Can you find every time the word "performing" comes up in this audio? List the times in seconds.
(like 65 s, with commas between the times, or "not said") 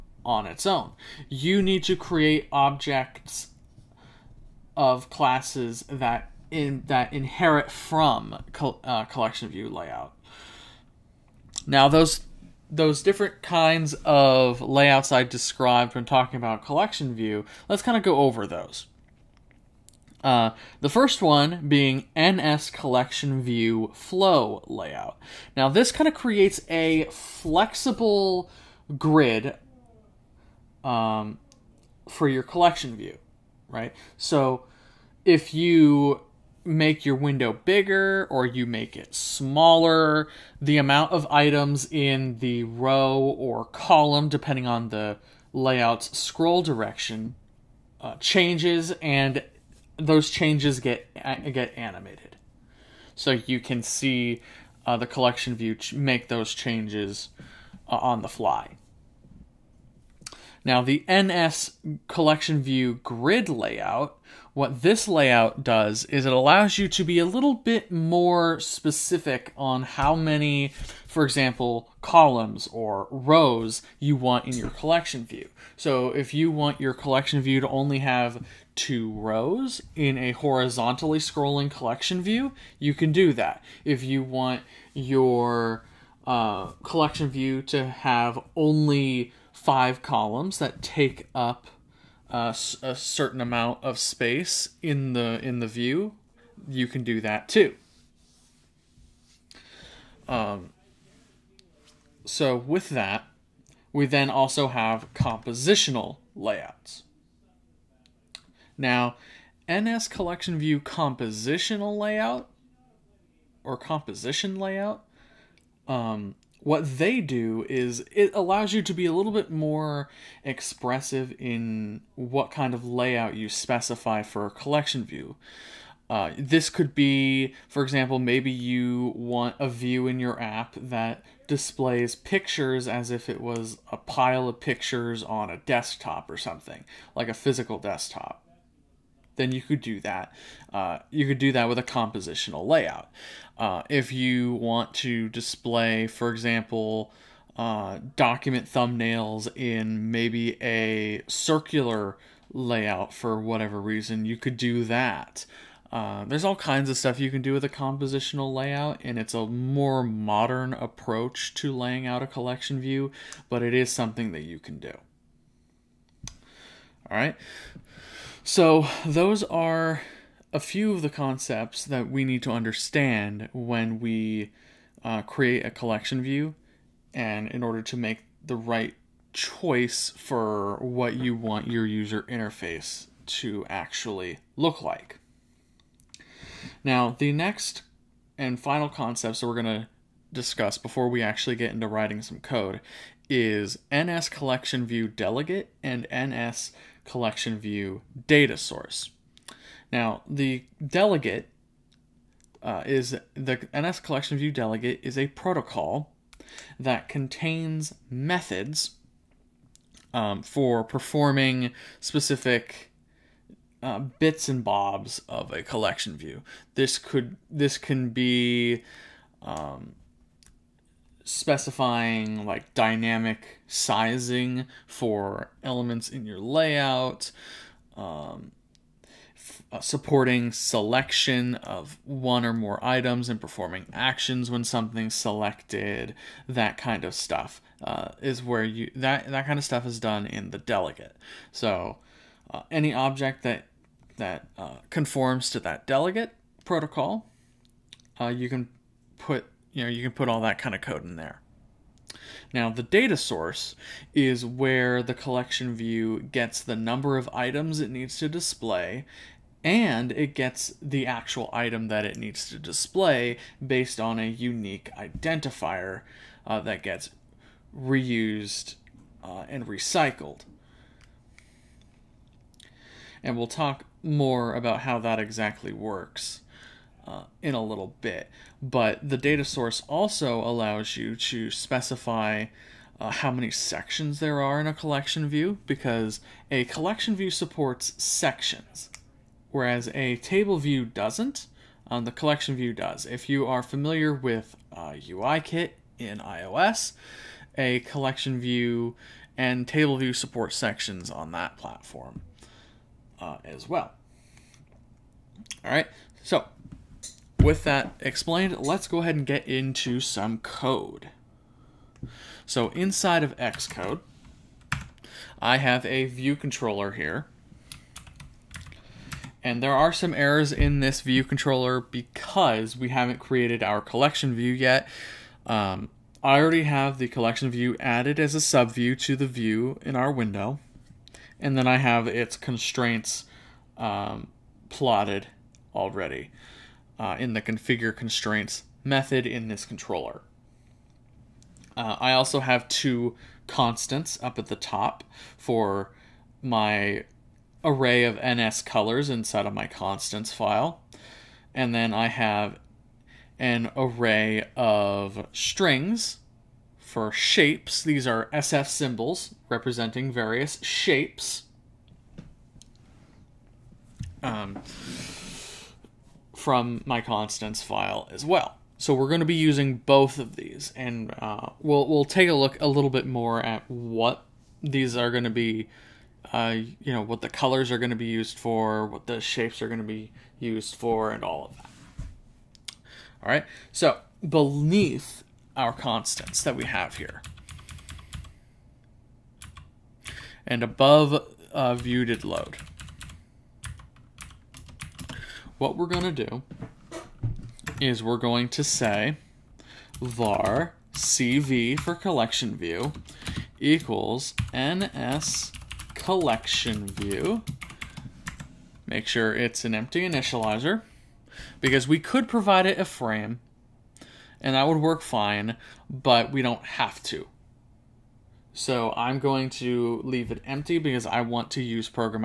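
210 s, 233 s.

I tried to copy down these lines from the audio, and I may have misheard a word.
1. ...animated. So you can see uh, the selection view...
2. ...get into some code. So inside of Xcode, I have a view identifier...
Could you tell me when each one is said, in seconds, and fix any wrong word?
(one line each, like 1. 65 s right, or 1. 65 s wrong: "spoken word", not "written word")
1. 51 s wrong: "collection", not "selection"
2. 309 s wrong: "controller", not "identifier".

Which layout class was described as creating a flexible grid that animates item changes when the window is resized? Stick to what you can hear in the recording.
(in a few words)
NS collection view flow layout.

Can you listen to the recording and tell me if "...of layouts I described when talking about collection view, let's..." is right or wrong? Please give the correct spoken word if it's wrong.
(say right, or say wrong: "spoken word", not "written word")
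right.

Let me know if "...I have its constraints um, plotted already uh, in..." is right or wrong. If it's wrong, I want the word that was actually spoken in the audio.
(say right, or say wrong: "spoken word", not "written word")
right.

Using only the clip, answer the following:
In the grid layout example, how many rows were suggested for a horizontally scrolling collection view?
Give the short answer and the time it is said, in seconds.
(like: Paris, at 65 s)
2, at 78 s.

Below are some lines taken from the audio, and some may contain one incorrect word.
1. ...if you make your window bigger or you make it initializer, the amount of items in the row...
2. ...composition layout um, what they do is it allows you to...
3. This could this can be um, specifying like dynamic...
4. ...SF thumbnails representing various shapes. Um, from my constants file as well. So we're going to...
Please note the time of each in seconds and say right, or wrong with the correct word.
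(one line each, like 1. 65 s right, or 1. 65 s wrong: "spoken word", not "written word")
1. 35 s wrong: "smaller", not "initializer"
2. 113 s right
3. 216 s right
4. 358 s wrong: "symbols", not "thumbnails".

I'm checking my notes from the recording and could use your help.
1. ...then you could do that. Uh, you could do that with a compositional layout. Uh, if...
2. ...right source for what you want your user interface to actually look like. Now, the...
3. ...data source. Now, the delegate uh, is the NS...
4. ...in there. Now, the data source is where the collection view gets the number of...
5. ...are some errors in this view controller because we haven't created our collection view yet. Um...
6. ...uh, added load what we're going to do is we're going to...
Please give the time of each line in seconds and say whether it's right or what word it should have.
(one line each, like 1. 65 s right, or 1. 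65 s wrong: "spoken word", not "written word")
1. 139 s right
2. 178 s wrong: "choice", not "source"
3. 198 s right
4. 251 s right
5. 319 s right
6. 391 s wrong: "viewed", not "added".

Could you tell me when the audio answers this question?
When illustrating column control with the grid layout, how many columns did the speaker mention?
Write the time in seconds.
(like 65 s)
89 s.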